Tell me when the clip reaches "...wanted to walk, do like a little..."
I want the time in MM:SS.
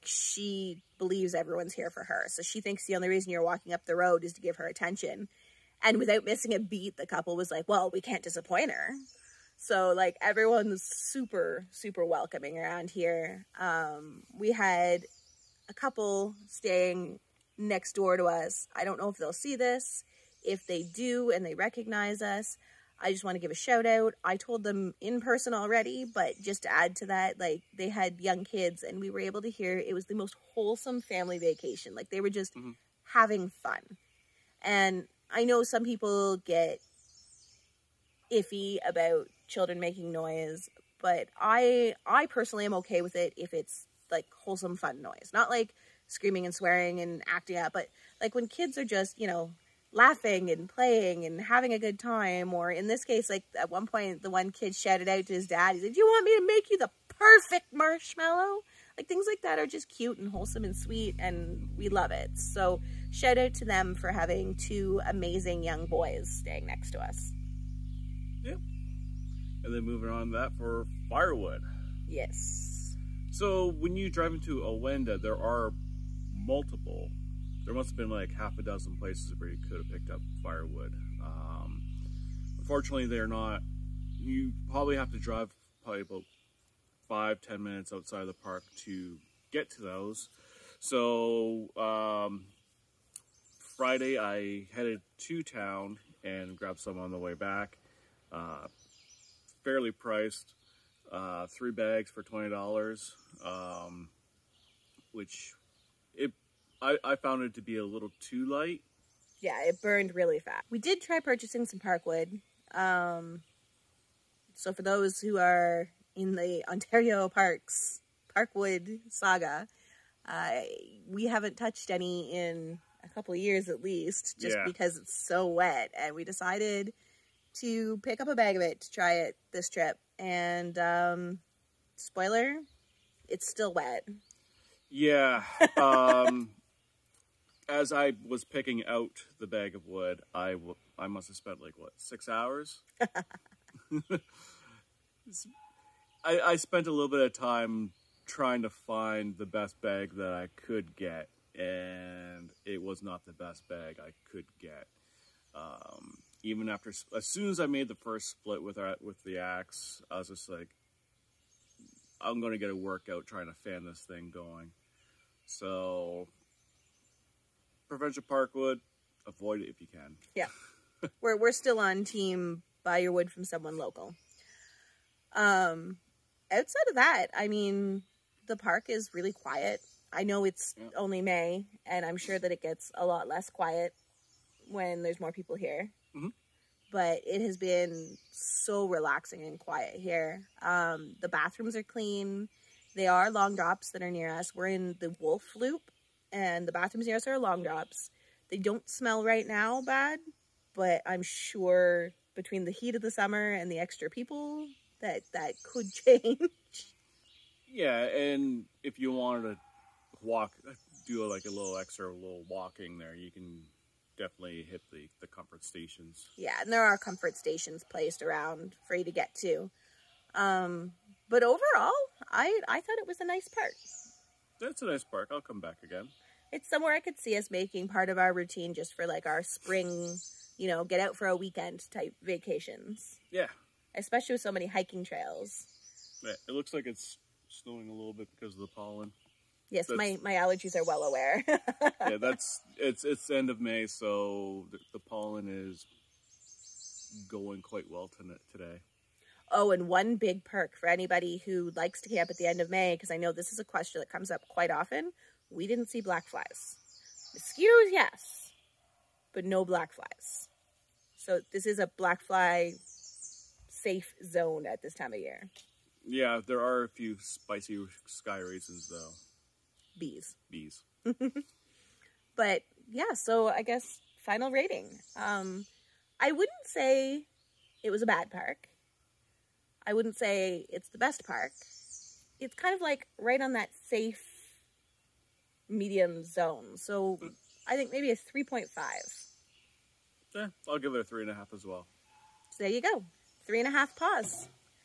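03:29.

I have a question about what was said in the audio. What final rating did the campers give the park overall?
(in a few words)
3.5.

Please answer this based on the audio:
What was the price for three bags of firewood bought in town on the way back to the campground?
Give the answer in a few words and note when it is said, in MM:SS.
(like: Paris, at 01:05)
$20, at 01:42.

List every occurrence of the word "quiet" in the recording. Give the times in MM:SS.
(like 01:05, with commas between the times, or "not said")
02:59, 03:03, 03:09.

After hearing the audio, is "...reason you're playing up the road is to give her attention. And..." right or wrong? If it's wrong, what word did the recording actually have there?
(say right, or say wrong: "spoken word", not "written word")
wrong: "walking", not "playing".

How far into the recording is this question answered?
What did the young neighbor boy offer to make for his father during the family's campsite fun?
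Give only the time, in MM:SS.
00:56.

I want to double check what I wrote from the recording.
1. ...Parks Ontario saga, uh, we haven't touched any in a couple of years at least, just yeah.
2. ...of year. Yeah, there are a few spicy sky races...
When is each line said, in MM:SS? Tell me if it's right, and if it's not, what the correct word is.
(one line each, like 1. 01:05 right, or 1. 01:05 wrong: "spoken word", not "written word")
1. 01:57 wrong: "Parkwood", not "Ontario"
2. 04:25 right.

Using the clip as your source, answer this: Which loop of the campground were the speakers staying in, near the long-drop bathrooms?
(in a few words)
Wolf Loop.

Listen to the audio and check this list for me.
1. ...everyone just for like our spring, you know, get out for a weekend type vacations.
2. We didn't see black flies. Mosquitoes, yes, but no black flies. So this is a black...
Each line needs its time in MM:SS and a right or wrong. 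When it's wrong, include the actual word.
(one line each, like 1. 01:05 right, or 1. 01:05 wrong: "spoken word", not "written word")
1. 03:48 wrong: "routine", not "everyone"
2. 04:15 right.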